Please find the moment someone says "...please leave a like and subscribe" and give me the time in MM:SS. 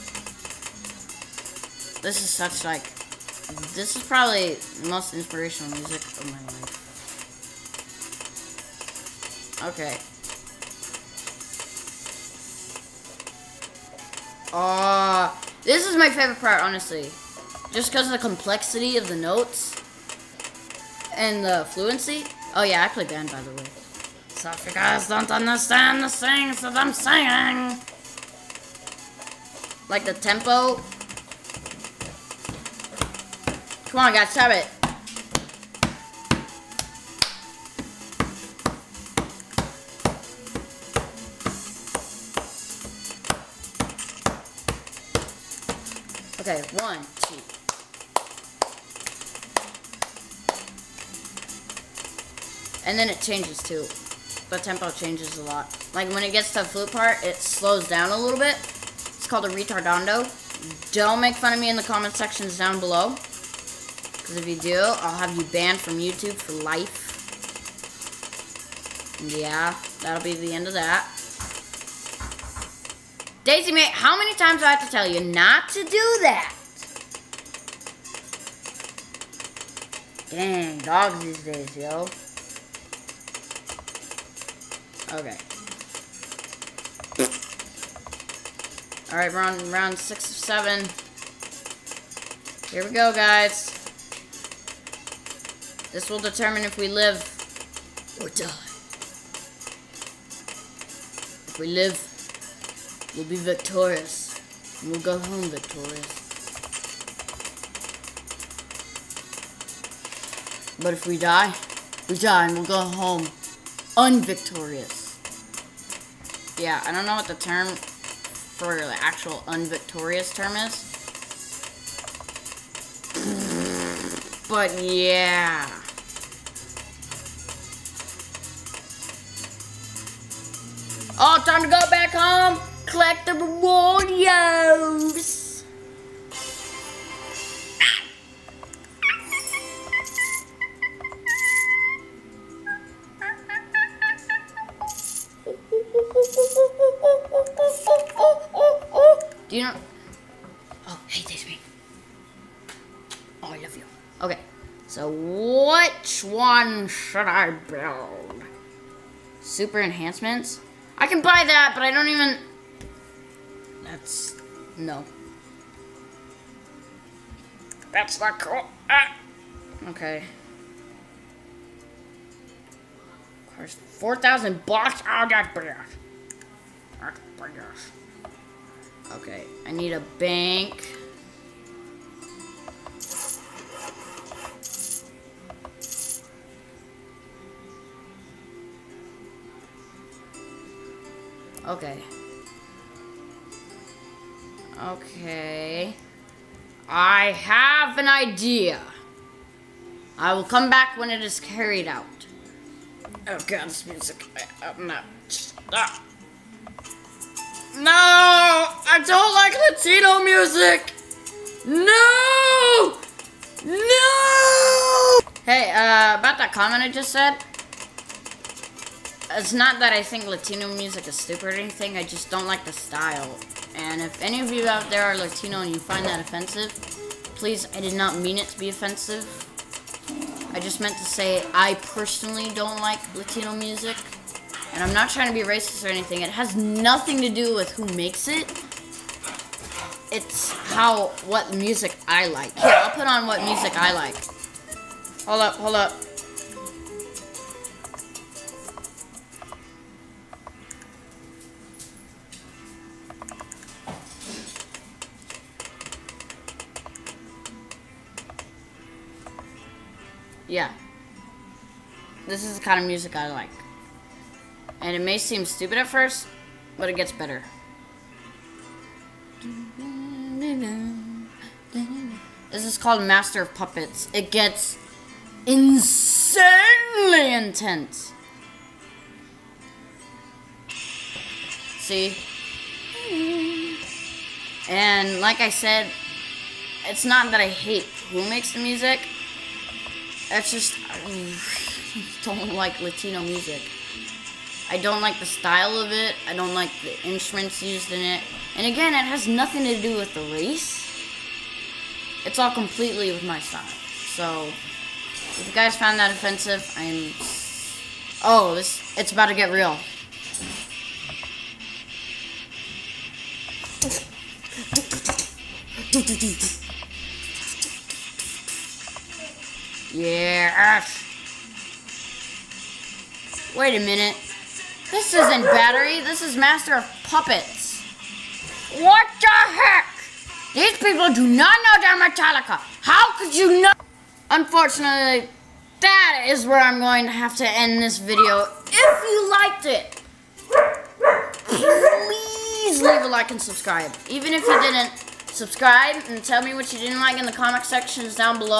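05:41.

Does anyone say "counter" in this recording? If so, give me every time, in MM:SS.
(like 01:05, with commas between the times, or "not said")
not said.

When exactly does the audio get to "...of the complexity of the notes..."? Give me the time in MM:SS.
00:18.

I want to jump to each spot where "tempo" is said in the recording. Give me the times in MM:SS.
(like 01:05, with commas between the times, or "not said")
00:30, 00:54.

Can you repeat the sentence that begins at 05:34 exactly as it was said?
Unfortunately, that is where I'm going to have to end this video.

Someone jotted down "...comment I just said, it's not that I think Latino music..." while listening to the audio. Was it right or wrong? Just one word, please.
right.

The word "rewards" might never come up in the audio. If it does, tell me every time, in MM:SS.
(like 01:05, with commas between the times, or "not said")
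02:13.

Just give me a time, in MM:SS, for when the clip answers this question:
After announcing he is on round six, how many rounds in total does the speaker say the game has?
01:30.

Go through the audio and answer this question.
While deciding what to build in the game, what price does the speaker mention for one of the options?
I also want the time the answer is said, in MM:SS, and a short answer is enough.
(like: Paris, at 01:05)
4,000 bucks, at 02:53.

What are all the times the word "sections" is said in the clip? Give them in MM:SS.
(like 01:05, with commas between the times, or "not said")
01:02, 05:47.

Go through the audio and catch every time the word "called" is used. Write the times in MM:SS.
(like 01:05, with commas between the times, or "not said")
00:59, 04:32.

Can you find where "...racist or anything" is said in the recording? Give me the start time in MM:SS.
03:55.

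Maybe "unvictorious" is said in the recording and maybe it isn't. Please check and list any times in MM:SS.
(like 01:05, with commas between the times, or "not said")
01:53, 01:59.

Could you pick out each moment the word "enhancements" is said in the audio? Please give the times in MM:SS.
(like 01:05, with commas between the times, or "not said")
02:39.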